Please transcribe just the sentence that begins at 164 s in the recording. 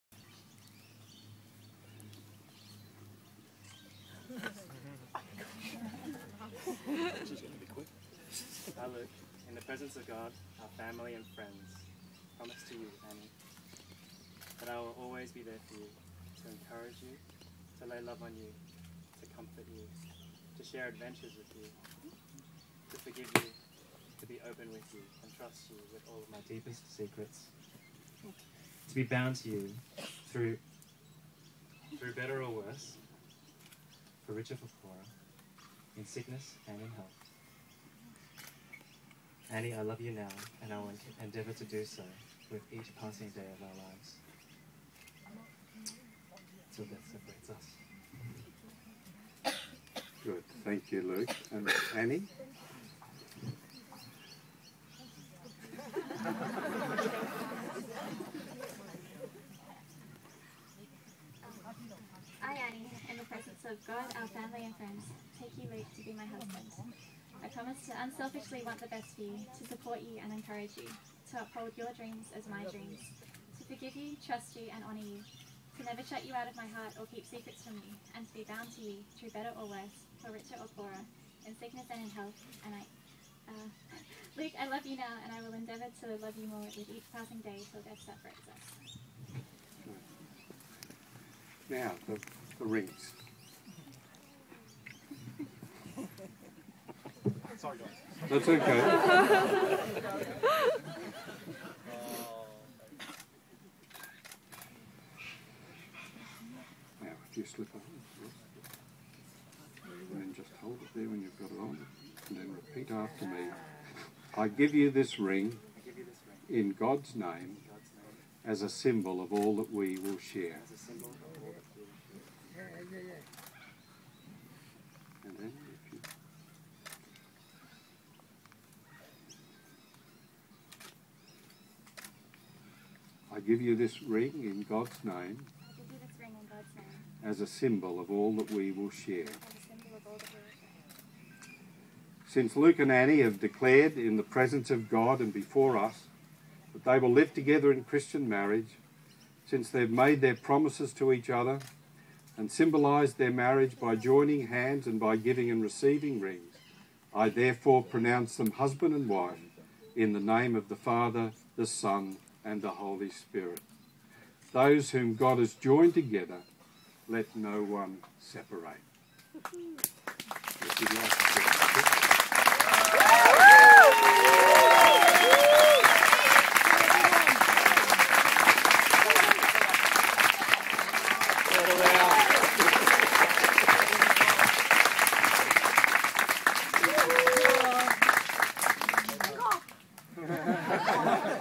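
Those whom God has joined together, let no one separate.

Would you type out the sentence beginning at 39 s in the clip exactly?
Anni, I love you now, and I will endeavor to do so with each passing day of our lives.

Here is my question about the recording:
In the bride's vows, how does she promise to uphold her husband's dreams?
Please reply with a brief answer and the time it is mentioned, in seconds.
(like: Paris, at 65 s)
My dreams, at 72 s.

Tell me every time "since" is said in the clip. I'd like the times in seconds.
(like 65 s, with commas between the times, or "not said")
142 s, 149 s.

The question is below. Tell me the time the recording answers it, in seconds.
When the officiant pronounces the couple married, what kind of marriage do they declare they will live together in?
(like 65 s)
147 s.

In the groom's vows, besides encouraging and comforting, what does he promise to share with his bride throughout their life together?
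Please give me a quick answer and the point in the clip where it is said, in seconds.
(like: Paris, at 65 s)
Adventures, at 20 s.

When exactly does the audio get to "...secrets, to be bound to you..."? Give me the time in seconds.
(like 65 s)
26 s.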